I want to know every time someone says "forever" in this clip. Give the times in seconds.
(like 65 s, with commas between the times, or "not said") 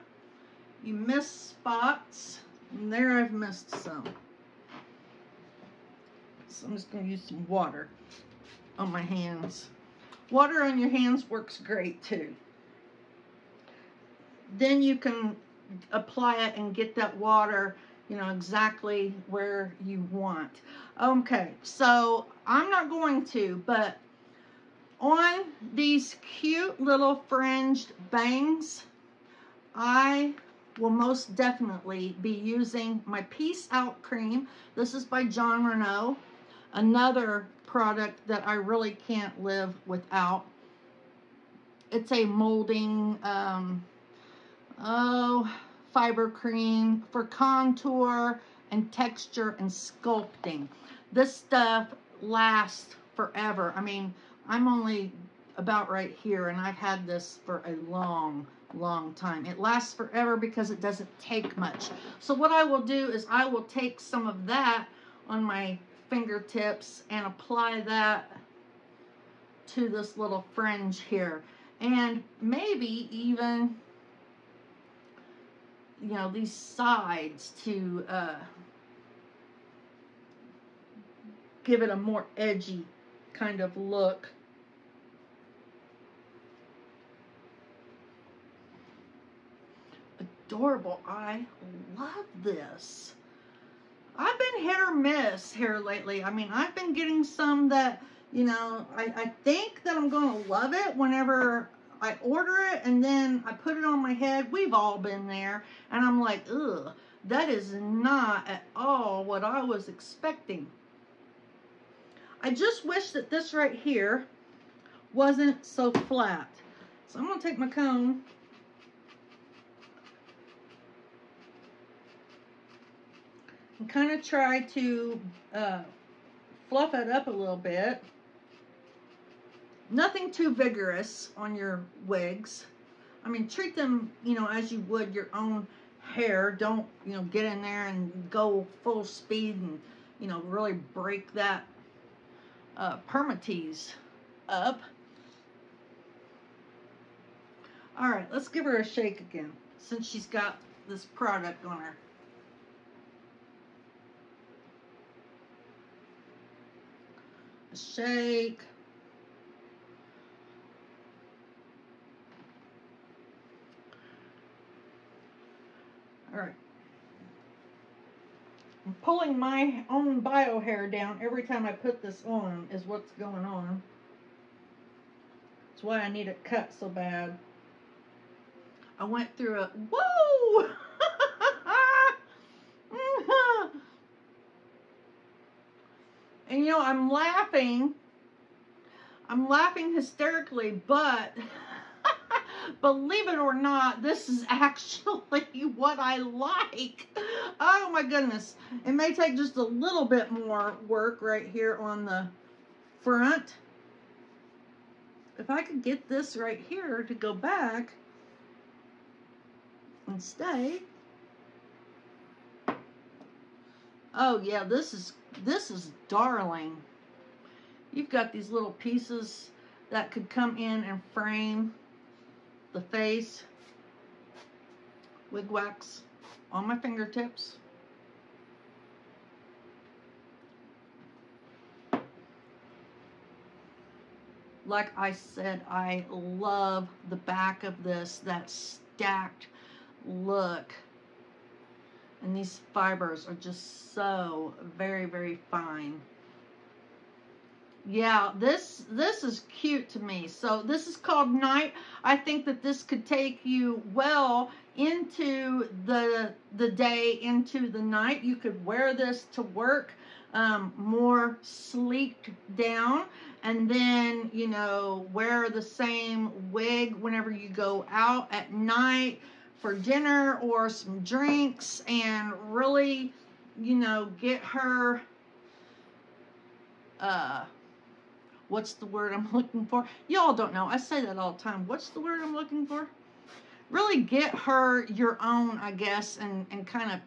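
53 s, 59 s.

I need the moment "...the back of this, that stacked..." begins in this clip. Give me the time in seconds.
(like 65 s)
237 s.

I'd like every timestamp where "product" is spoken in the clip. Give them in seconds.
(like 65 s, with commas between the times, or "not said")
37 s, 151 s.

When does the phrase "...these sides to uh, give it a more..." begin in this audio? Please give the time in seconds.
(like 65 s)
76 s.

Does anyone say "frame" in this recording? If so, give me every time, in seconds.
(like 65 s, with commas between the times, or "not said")
221 s.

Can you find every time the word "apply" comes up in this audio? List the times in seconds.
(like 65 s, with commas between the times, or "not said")
15 s, 67 s.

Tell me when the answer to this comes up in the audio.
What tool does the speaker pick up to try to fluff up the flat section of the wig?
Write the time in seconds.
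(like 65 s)
117 s.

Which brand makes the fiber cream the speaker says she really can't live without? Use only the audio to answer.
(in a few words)
Jon Renau.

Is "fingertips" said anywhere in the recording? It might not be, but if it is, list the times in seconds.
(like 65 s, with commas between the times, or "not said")
66 s, 226 s.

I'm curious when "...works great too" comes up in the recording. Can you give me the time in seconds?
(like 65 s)
11 s.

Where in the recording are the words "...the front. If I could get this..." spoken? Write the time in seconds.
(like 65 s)
202 s.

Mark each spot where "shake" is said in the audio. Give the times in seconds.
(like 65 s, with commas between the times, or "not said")
148 s, 157 s.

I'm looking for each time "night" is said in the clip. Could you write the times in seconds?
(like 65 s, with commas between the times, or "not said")
251 s, 257 s, 268 s.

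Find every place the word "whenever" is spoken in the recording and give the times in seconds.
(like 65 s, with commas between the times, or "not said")
100 s, 266 s.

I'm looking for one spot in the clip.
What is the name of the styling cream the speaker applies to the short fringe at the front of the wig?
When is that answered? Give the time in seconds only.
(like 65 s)
33 s.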